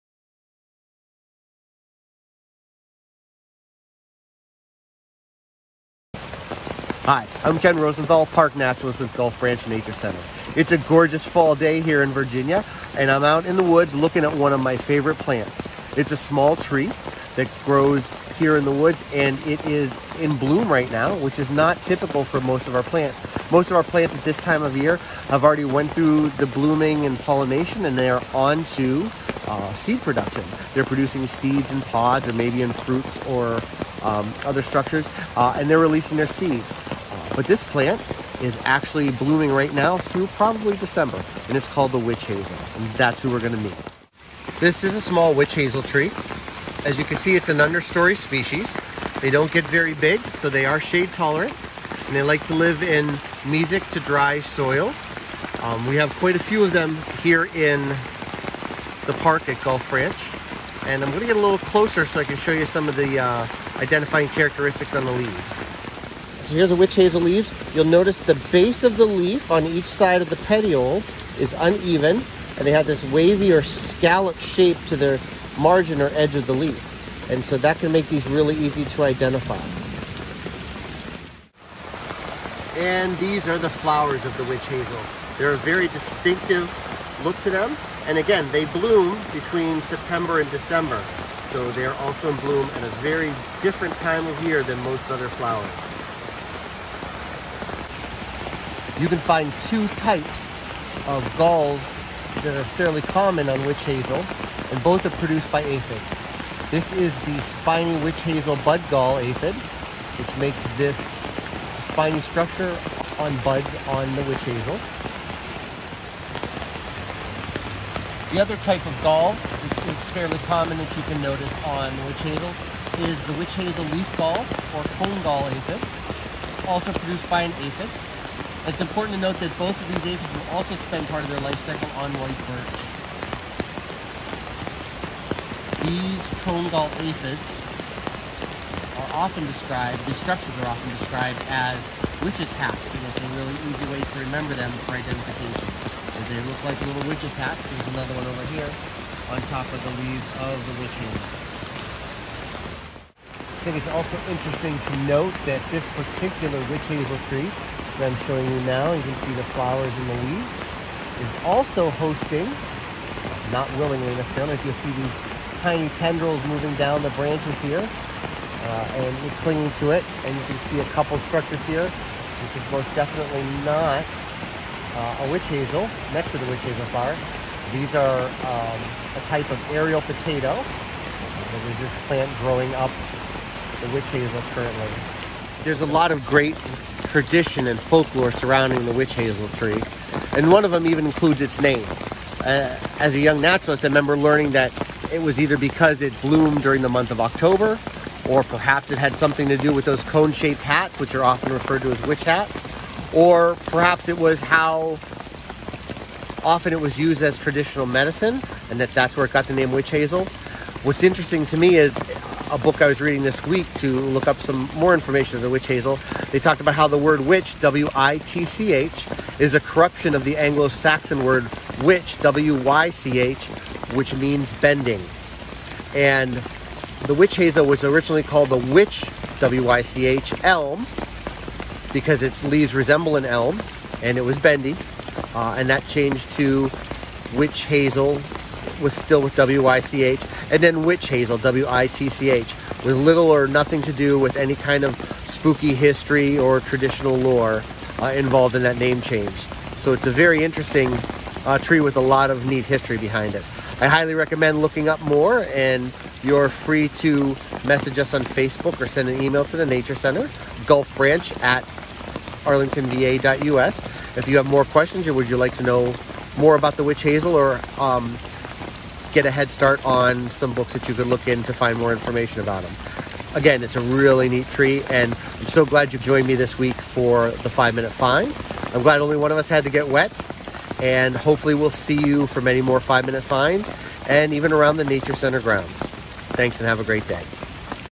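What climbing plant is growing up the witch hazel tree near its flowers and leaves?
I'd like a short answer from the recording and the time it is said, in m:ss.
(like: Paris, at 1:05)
aerial potato, at 2:59.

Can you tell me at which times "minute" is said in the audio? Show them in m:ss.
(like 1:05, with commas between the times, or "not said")
4:37, 4:43.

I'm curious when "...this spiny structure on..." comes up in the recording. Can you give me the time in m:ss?
1:50.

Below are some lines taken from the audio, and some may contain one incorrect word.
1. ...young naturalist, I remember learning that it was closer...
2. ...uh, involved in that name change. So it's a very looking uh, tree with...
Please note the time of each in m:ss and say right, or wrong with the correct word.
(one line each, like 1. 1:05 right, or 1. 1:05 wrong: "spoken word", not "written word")
1. 3:13 wrong: "either", not "closer"
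2. 4:08 wrong: "interesting", not "looking".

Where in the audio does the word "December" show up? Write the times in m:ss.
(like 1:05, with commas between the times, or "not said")
0:40, 1:30.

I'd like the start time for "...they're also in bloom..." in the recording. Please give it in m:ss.
1:31.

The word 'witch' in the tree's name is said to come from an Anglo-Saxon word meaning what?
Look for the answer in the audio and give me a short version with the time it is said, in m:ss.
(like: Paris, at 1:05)
bending, at 3:44.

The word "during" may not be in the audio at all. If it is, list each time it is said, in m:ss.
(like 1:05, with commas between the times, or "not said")
3:16.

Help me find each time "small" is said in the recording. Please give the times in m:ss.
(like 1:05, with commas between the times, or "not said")
0:16, 0:45.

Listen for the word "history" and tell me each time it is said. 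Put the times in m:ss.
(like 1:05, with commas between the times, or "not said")
4:05, 4:12.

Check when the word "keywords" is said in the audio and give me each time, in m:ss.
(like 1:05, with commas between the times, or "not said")
not said.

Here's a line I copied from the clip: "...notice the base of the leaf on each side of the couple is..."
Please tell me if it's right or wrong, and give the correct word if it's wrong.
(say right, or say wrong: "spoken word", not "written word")
wrong: "petiole", not "couple".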